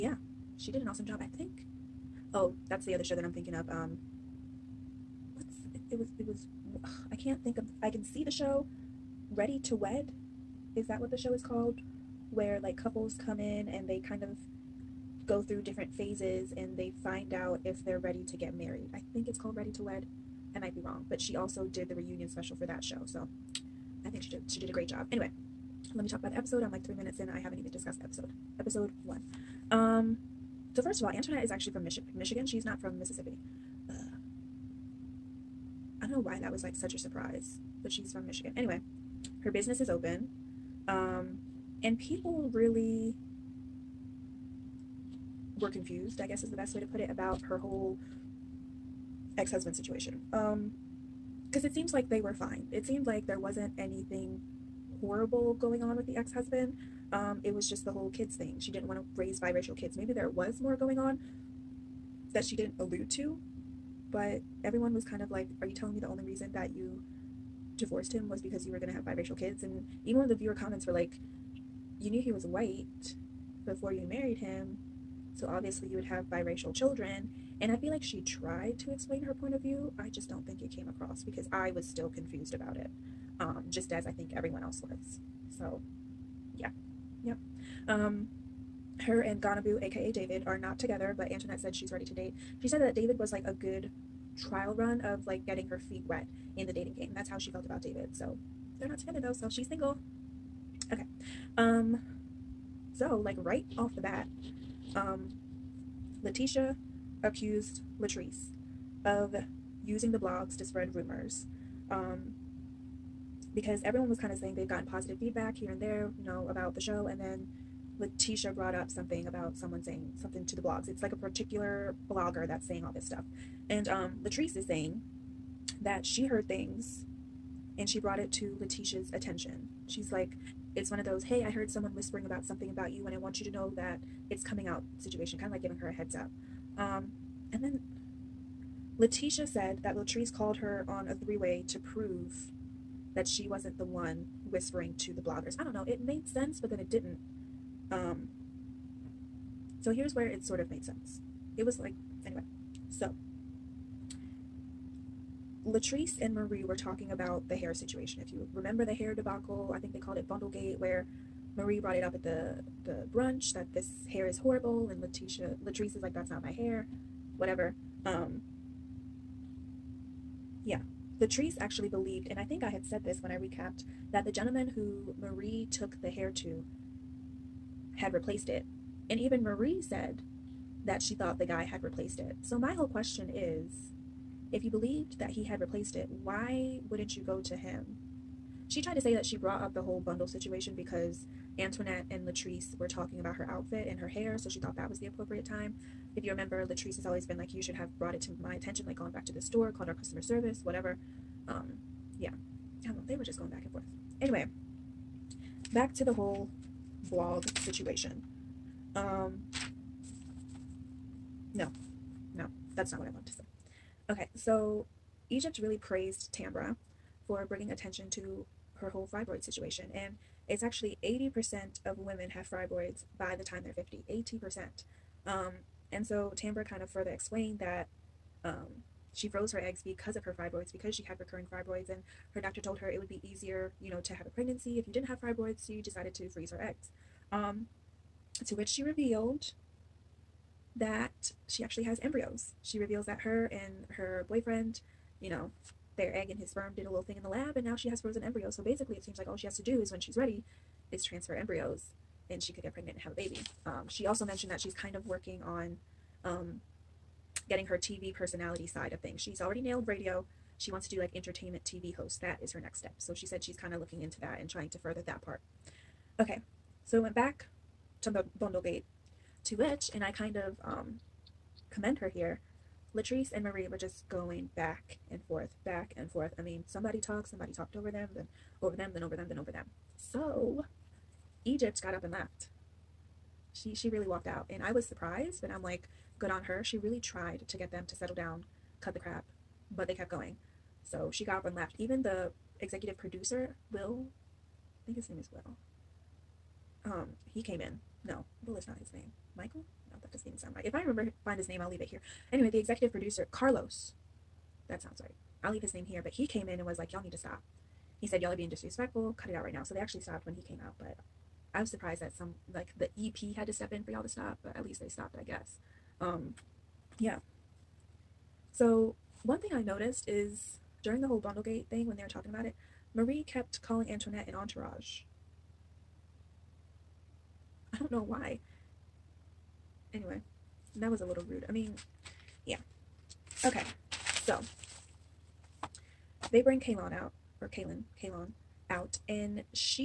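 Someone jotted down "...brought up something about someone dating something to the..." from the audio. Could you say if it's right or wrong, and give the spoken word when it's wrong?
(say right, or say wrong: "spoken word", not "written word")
wrong: "saying", not "dating".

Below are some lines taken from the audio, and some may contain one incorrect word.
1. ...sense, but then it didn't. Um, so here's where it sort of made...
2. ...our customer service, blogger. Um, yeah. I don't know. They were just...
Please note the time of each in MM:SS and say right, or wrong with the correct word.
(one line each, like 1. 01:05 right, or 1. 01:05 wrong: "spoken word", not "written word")
1. 02:26 right
2. 03:19 wrong: "whatever", not "blogger".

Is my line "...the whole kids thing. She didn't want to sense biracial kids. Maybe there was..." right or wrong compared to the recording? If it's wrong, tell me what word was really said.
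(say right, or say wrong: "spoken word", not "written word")
wrong: "raise", not "sense".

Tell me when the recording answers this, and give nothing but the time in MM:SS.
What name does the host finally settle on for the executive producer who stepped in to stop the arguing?
05:03.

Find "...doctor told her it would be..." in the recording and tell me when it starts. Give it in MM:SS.
03:52.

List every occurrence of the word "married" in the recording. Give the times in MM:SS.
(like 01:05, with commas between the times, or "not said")
00:18, 01:14.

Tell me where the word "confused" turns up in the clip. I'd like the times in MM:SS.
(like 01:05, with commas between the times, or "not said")
00:45, 01:22.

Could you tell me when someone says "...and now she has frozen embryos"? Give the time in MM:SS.
04:07.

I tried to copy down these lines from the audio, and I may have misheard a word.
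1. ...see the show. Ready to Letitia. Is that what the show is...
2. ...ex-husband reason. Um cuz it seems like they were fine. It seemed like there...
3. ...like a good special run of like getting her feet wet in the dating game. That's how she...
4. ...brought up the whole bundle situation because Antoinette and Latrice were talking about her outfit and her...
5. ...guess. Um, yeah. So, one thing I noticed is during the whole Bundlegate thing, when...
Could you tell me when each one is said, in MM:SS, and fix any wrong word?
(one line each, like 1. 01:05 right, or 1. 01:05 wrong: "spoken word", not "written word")
1. 00:08 wrong: "Wed", not "Letitia"
2. 00:49 wrong: "situation", not "reason"
3. 01:33 wrong: "trial", not "special"
4. 03:09 right
5. 05:15 right.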